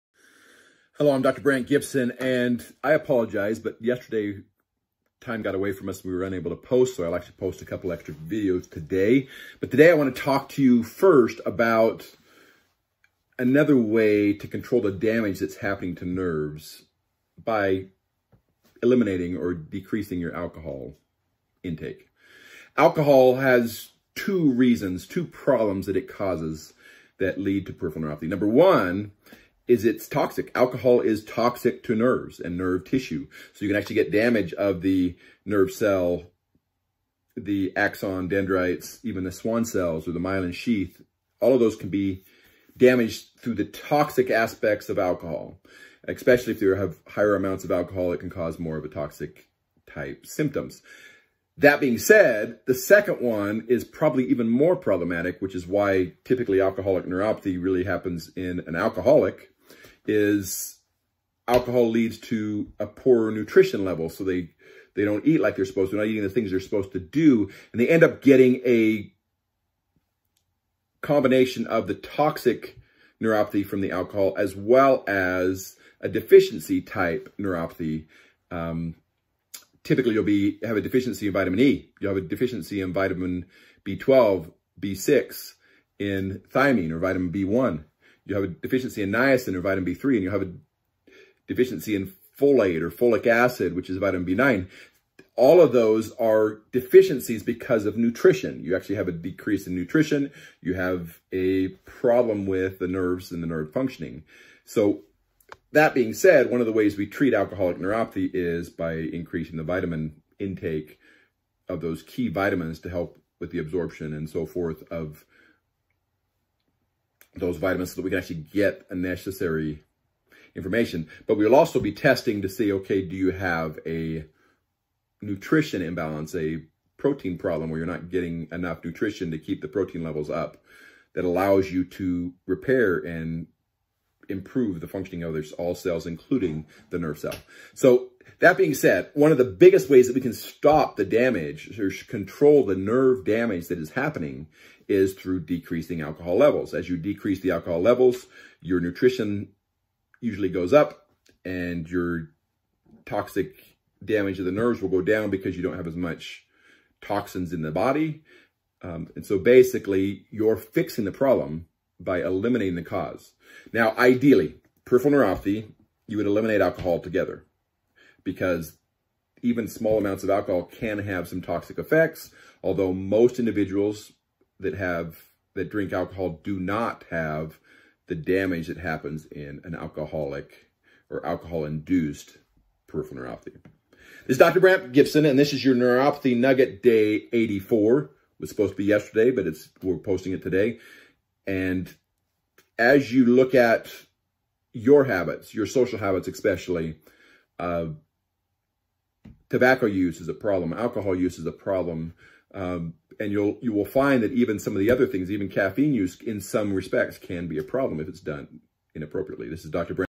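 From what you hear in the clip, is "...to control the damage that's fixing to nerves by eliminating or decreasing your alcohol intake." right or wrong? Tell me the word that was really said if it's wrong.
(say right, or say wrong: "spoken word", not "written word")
wrong: "happening", not "fixing".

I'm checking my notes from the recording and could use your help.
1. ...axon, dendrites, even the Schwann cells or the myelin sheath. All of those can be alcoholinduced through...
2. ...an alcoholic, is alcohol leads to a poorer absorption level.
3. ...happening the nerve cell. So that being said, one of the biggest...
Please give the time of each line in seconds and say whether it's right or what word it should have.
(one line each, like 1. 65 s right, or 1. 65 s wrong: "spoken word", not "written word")
1. 37 s wrong: "damaged", not "alcoholinduced"
2. 58 s wrong: "nutrition", not "absorption"
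3. 136 s wrong: "including", not "happening".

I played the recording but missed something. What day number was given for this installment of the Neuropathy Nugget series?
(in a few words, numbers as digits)
84.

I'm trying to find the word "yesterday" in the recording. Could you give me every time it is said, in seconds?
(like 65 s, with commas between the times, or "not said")
3 s, 188 s.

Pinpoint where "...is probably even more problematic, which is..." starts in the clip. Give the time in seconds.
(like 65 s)
53 s.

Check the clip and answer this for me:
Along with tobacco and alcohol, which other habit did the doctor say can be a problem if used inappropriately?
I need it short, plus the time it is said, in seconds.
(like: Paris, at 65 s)
Caffeine, at 205 s.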